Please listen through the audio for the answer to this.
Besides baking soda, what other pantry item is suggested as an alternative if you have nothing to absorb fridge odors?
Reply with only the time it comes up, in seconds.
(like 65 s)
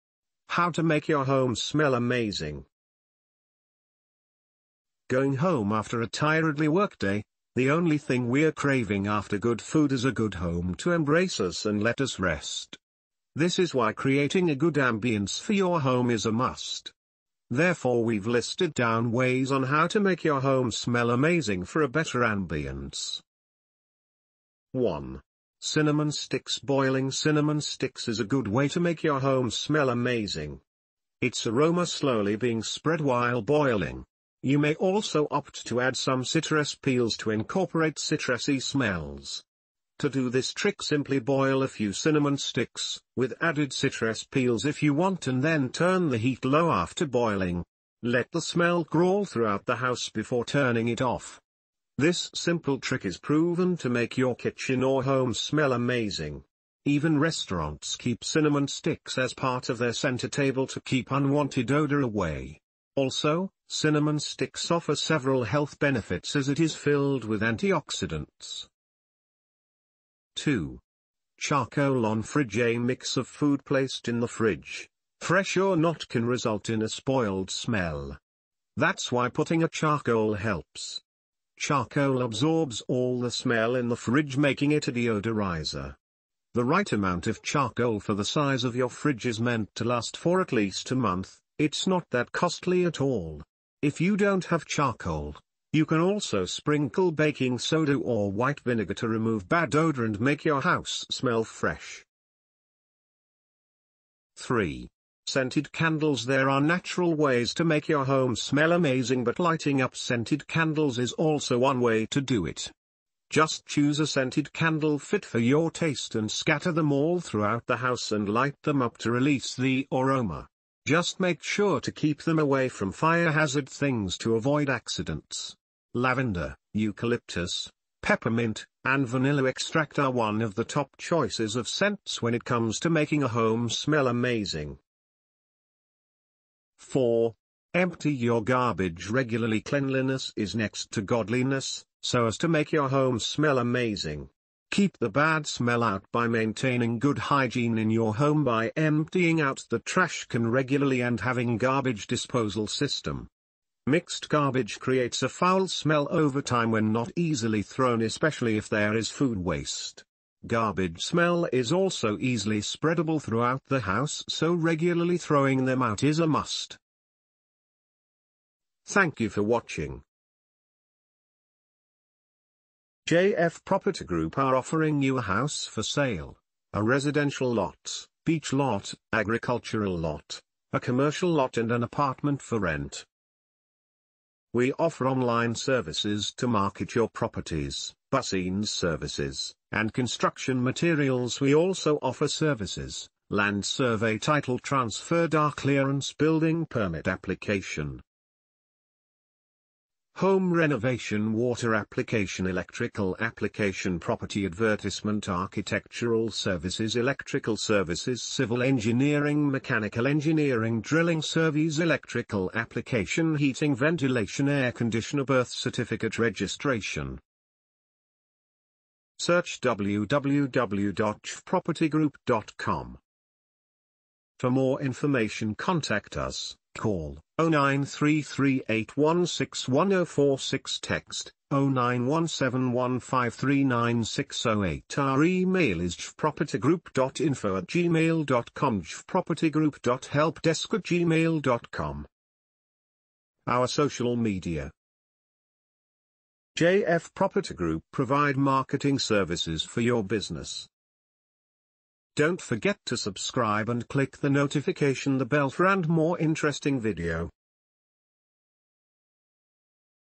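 98 s.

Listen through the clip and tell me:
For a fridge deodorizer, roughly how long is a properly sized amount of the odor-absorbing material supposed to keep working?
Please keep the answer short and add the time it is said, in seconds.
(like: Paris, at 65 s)
a month, at 90 s.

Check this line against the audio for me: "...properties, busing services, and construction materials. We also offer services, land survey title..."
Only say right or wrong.
right.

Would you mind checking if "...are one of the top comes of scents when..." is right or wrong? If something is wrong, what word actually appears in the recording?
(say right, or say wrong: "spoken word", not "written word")
wrong: "choices", not "comes".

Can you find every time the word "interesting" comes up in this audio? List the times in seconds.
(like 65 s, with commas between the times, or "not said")
256 s.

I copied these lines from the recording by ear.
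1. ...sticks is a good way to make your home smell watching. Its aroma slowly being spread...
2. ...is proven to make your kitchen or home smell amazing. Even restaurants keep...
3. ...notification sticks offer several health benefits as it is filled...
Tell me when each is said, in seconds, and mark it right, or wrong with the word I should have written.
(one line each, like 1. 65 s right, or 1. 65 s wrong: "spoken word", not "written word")
1. 27 s wrong: "amazing", not "watching"
2. 53 s right
3. 63 s wrong: "cinnamon", not "notification".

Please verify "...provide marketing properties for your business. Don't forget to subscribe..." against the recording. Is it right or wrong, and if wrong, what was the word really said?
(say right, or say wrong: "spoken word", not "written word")
wrong: "services", not "properties".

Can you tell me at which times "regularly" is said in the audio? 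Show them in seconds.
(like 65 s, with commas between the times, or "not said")
139 s, 150 s, 164 s.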